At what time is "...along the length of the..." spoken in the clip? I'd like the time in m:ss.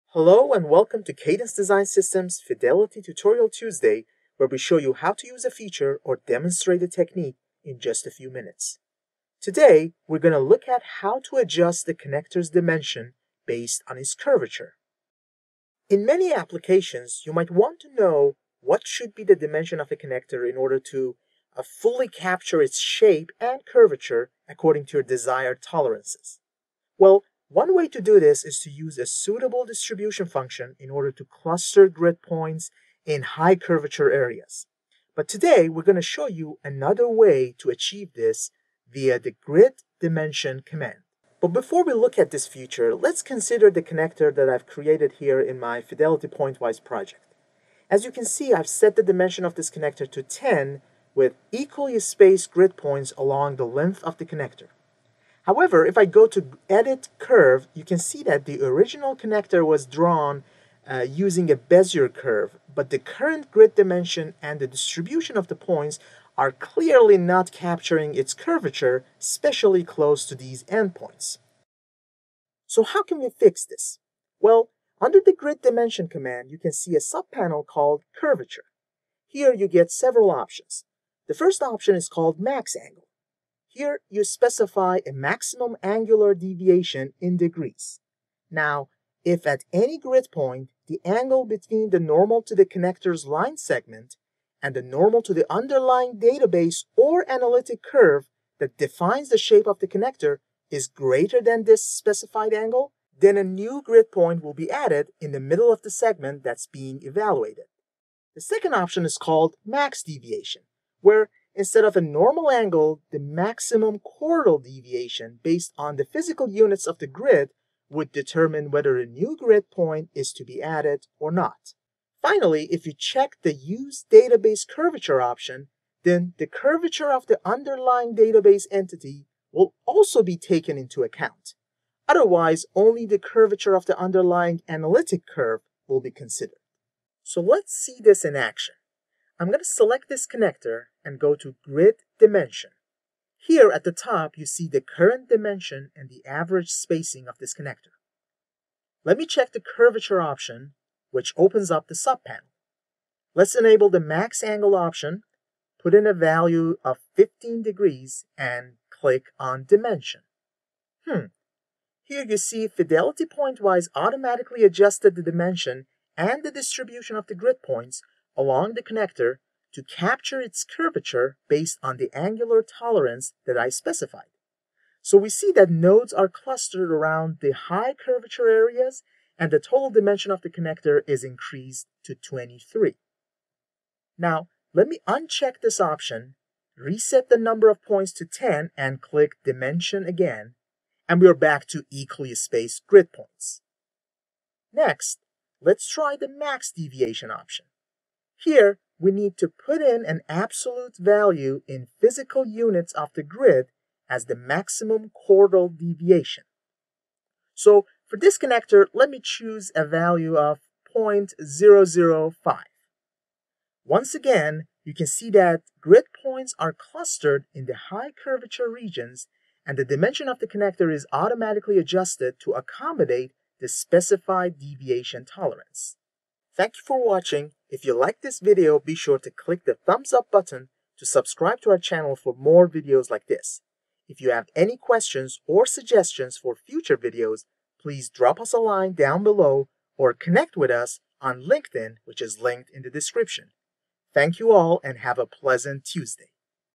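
0:53.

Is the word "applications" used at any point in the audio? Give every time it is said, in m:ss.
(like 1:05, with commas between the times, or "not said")
0:16.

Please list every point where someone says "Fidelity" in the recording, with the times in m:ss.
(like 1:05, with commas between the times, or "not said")
0:02, 0:45, 2:42.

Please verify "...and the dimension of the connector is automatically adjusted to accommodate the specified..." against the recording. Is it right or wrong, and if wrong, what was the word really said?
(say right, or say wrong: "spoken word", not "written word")
right.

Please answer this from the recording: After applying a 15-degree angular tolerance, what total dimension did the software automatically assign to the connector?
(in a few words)
23.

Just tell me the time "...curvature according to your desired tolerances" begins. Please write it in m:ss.
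0:23.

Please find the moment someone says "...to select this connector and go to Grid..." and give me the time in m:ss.
2:19.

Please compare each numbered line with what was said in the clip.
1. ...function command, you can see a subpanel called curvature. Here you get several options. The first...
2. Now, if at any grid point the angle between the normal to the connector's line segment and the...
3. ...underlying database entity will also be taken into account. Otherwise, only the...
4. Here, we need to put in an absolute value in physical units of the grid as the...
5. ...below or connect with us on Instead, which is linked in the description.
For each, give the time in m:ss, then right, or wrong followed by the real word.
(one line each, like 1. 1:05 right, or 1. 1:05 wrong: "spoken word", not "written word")
1. 1:15 wrong: "dimension", not "function"
2. 1:28 right
3. 2:07 right
4. 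3:18 right
5. 3:59 wrong: "LinkedIn", not "Instead".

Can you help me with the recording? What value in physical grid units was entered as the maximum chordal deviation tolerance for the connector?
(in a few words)
0.005.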